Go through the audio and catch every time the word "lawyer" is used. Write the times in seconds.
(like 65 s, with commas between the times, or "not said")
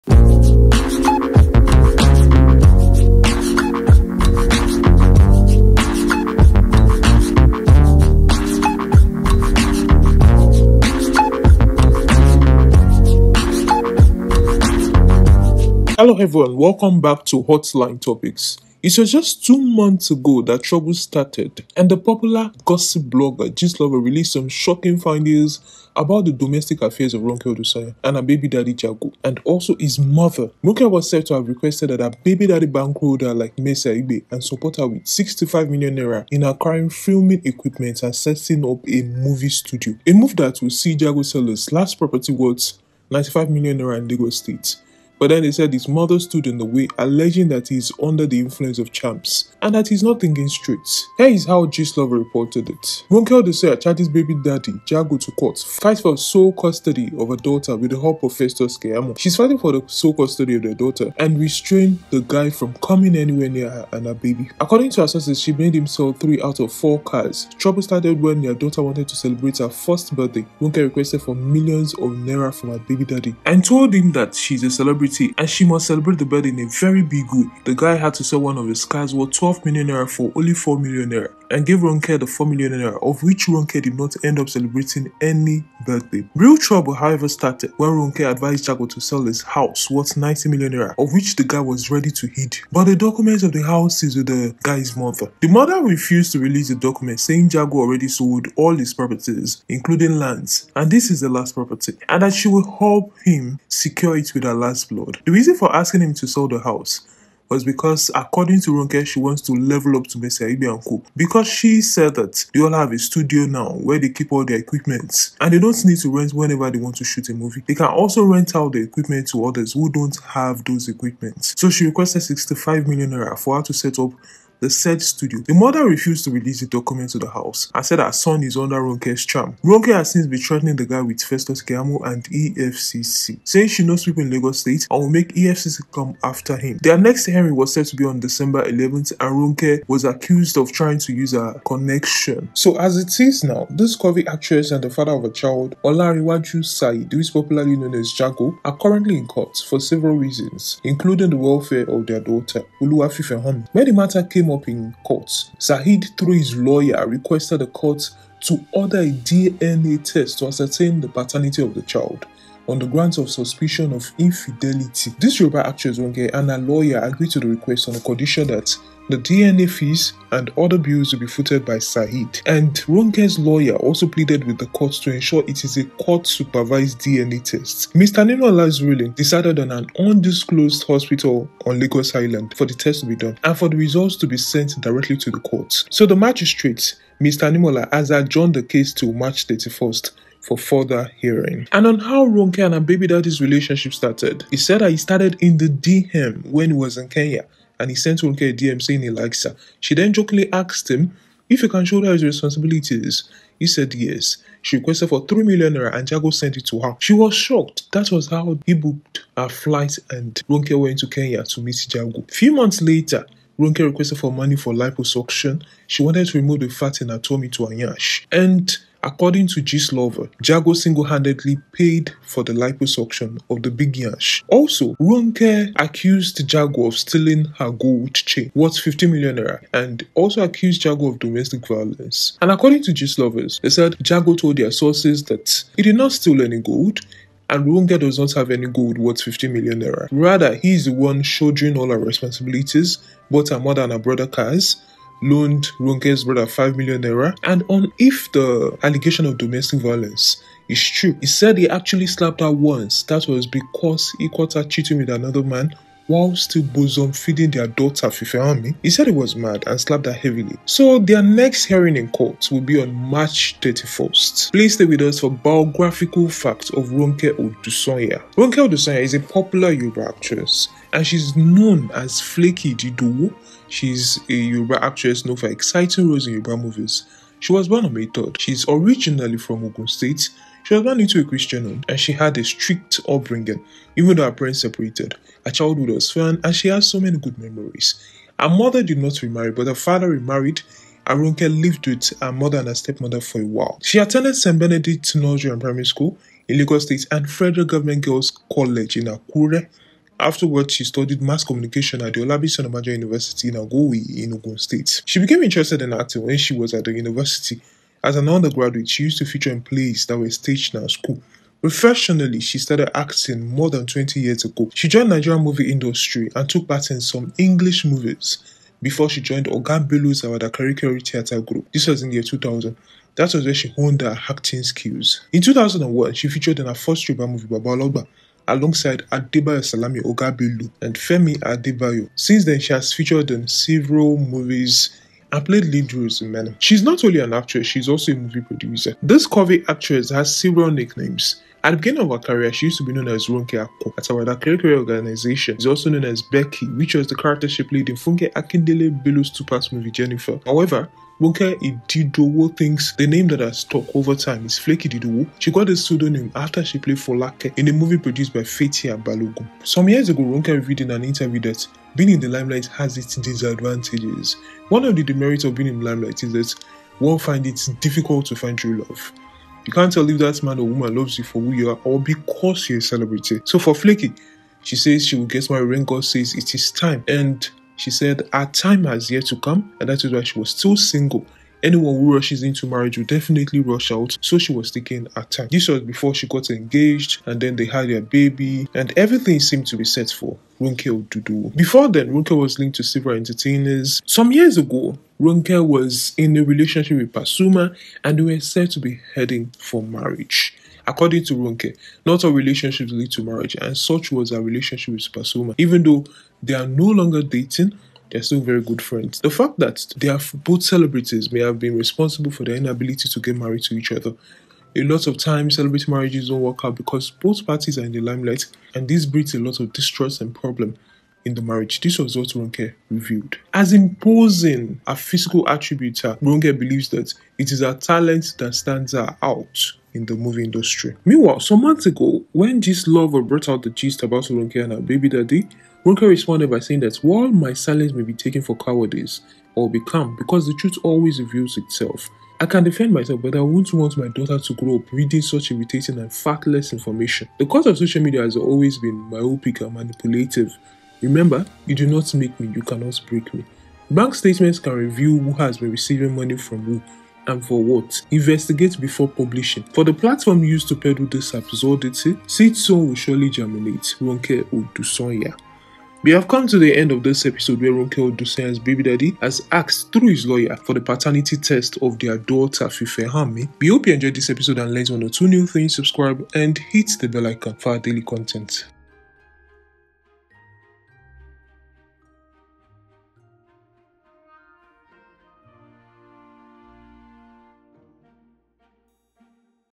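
156 s, 166 s, 173 s, 470 s.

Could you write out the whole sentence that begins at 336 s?
She's not only an actress, she's also a movie producer.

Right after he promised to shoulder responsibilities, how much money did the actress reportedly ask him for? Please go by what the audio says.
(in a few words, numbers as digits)
3 million naira.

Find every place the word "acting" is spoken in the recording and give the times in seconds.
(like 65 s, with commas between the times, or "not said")
305 s, 312 s, 324 s.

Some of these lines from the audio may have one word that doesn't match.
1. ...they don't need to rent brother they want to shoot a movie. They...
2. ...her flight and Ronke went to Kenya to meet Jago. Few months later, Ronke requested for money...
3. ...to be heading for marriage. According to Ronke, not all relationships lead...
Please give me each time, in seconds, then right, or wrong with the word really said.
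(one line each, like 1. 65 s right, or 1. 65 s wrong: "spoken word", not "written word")
1. 115 s wrong: "whenever", not "brother"
2. 209 s right
3. 398 s right.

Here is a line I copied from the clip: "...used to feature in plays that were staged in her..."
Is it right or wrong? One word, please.
right.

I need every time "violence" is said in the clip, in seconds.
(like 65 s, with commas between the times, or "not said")
231 s, 249 s.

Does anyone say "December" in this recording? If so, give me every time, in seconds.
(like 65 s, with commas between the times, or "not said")
138 s.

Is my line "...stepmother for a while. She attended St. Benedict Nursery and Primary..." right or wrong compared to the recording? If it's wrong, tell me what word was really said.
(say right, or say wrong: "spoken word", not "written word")
right.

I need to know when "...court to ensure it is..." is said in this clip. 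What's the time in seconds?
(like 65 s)
174 s.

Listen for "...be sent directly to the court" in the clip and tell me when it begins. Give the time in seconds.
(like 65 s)
184 s.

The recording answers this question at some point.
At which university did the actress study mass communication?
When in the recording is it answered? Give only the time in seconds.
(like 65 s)
302 s.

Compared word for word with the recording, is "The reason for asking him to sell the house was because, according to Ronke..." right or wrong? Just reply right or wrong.
right.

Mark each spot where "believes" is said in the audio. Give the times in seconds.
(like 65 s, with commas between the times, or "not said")
426 s.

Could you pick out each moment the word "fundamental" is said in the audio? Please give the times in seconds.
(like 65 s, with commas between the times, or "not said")
not said.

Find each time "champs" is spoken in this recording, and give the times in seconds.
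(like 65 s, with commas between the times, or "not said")
48 s.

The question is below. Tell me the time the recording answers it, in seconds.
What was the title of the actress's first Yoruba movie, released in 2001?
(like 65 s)
327 s.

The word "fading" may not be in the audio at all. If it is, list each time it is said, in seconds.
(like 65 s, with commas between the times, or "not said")
not said.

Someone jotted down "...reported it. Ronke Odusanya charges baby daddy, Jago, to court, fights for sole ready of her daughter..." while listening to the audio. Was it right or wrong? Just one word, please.
wrong.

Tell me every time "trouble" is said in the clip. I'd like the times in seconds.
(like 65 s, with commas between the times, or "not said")
20 s, 67 s, 86 s.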